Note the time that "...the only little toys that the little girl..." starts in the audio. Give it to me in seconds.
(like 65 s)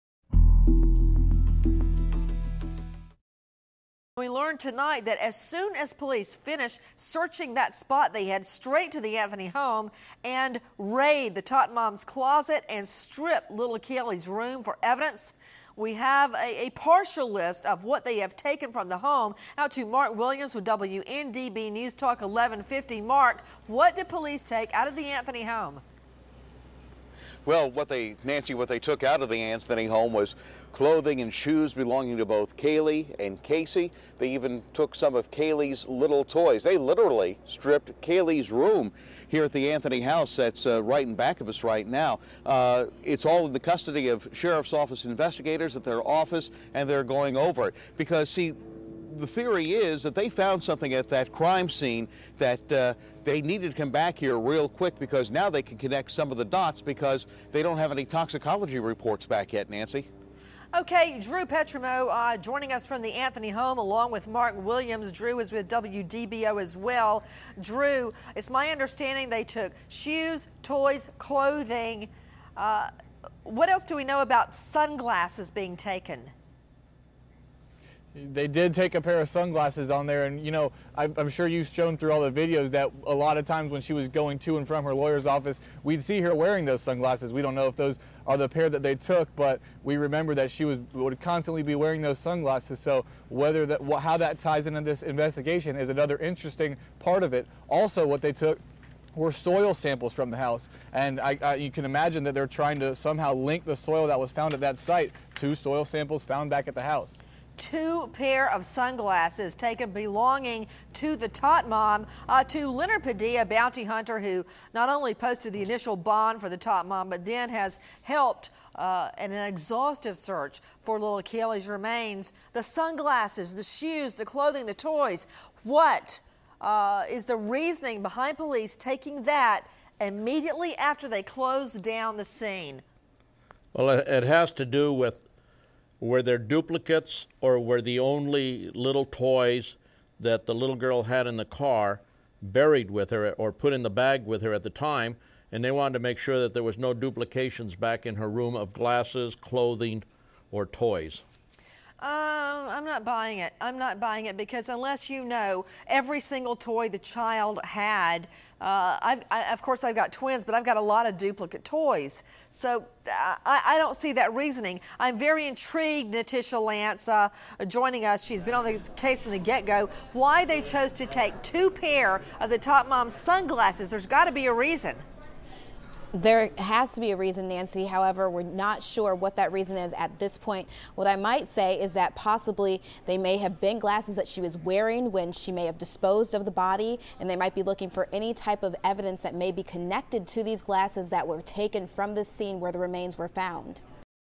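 137 s.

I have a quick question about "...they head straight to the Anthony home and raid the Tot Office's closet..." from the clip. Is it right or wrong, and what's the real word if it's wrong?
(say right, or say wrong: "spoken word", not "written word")
wrong: "Mom", not "Office".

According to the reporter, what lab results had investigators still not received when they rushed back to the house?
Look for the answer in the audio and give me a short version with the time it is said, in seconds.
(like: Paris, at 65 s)
toxicology reports, at 58 s.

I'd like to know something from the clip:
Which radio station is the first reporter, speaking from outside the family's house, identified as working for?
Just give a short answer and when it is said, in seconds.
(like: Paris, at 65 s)
WNDB News Talk 1150, at 20 s.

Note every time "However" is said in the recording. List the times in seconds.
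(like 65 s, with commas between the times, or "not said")
177 s.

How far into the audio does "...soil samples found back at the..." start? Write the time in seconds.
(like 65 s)
105 s.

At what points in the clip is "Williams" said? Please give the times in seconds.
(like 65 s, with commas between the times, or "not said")
20 s, 64 s.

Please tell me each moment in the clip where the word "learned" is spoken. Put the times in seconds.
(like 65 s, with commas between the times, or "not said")
4 s.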